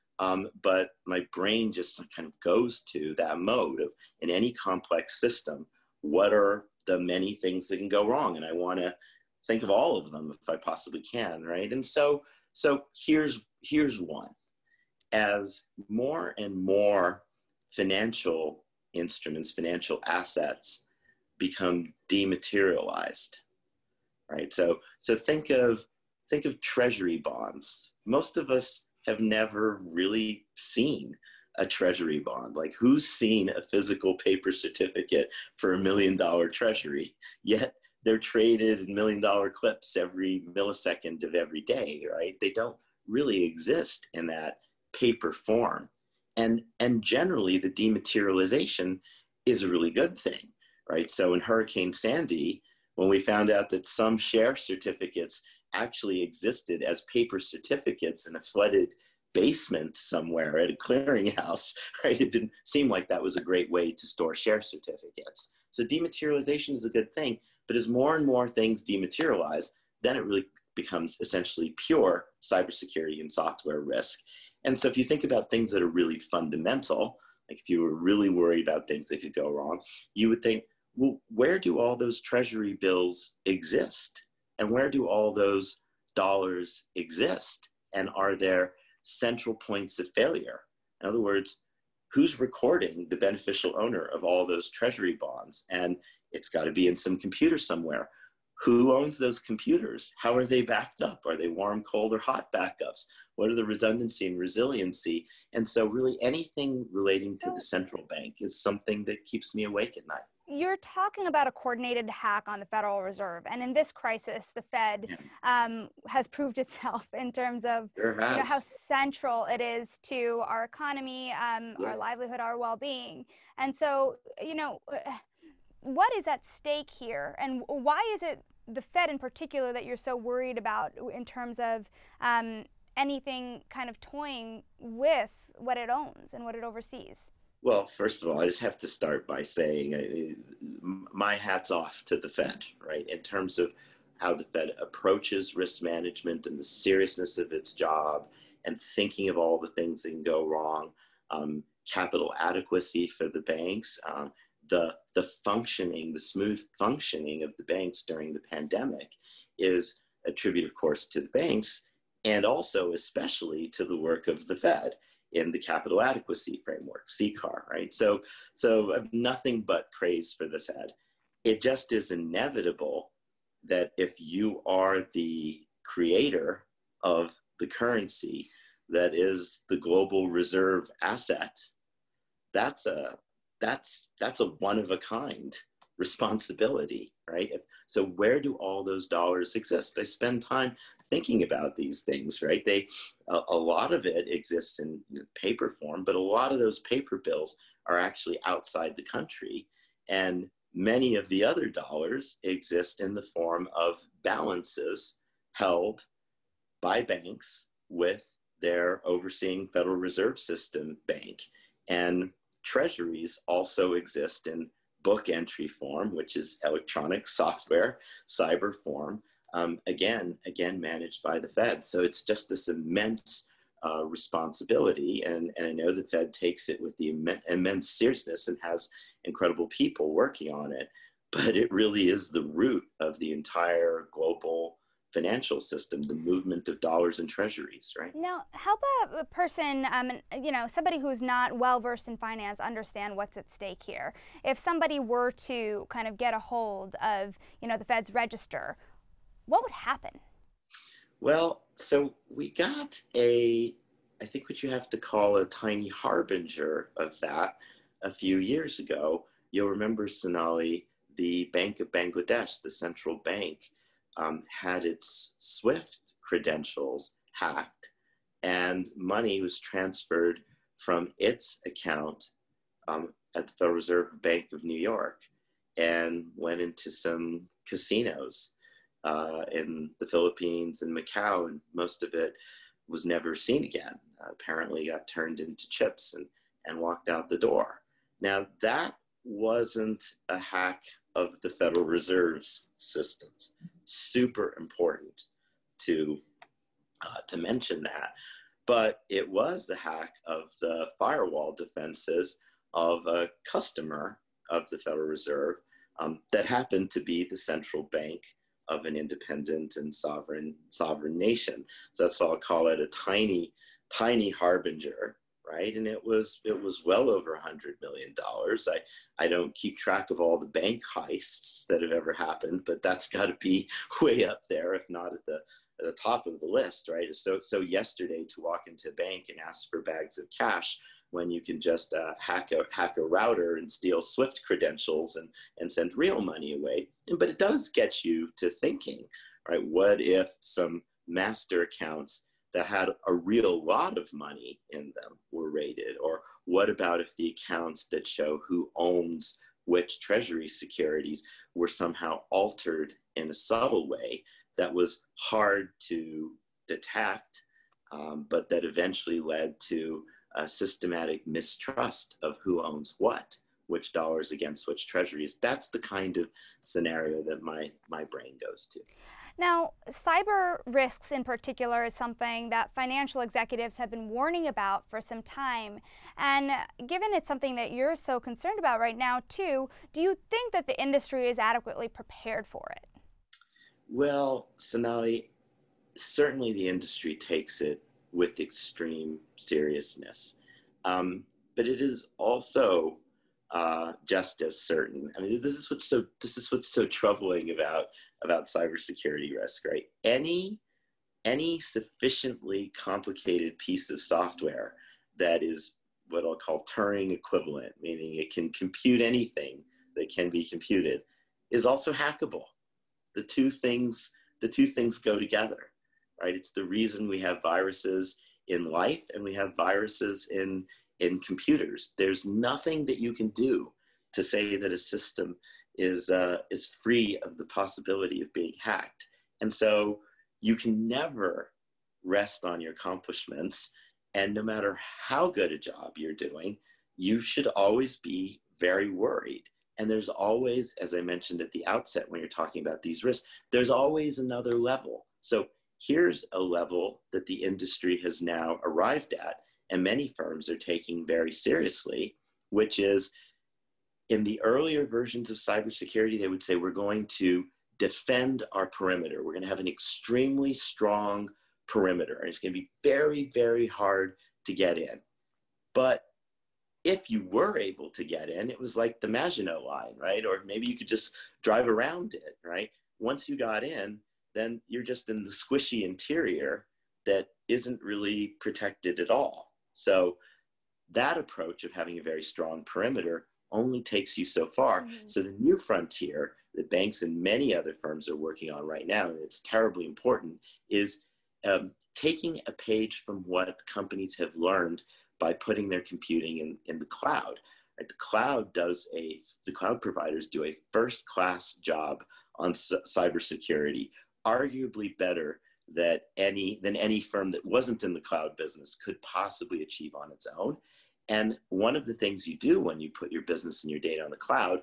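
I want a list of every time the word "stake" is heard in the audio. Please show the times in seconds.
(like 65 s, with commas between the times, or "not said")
126 s, 243 s.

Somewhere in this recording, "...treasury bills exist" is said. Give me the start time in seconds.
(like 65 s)
82 s.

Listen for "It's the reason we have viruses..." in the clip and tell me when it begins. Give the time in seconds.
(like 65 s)
416 s.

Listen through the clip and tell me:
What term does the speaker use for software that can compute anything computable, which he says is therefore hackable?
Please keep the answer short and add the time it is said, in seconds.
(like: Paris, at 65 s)
Turing equivalent, at 406 s.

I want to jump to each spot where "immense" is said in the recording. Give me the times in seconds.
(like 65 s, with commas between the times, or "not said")
222 s, 227 s.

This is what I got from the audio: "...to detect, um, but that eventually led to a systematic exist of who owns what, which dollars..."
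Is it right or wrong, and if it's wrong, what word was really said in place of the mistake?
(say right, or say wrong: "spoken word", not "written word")
wrong: "mistrust", not "exist".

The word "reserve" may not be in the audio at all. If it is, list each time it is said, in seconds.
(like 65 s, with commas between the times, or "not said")
113 s, 180 s, 209 s, 273 s, 291 s, 305 s.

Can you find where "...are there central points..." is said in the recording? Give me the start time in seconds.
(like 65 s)
88 s.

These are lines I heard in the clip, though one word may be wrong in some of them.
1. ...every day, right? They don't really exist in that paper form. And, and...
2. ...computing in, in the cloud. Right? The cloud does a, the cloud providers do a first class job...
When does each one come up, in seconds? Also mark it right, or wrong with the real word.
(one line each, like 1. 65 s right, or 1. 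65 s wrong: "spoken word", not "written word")
1. 41 s right
2. 495 s right.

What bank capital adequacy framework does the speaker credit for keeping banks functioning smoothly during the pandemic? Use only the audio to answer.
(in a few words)
CCAR.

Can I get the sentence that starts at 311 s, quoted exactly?
So that's why I'll call it a tiny, tiny harbinger, right?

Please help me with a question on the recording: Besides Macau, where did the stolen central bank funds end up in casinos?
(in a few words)
the Philippines.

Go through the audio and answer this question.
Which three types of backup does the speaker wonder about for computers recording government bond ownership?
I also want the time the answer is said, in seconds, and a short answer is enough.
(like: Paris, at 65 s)
warm, cold, or hot, at 101 s.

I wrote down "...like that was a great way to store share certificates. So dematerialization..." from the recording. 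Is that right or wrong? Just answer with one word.
right.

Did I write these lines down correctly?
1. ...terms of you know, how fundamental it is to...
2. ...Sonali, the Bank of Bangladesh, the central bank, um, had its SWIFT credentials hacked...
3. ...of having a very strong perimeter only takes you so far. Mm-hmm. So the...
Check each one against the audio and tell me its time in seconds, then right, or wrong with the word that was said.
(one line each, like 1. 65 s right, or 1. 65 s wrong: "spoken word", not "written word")
1. 117 s wrong: "central", not "fundamental"
2. 260 s right
3. 481 s right.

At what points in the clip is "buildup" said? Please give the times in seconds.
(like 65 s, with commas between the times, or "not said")
not said.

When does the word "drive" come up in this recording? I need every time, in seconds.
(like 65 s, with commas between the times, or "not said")
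471 s.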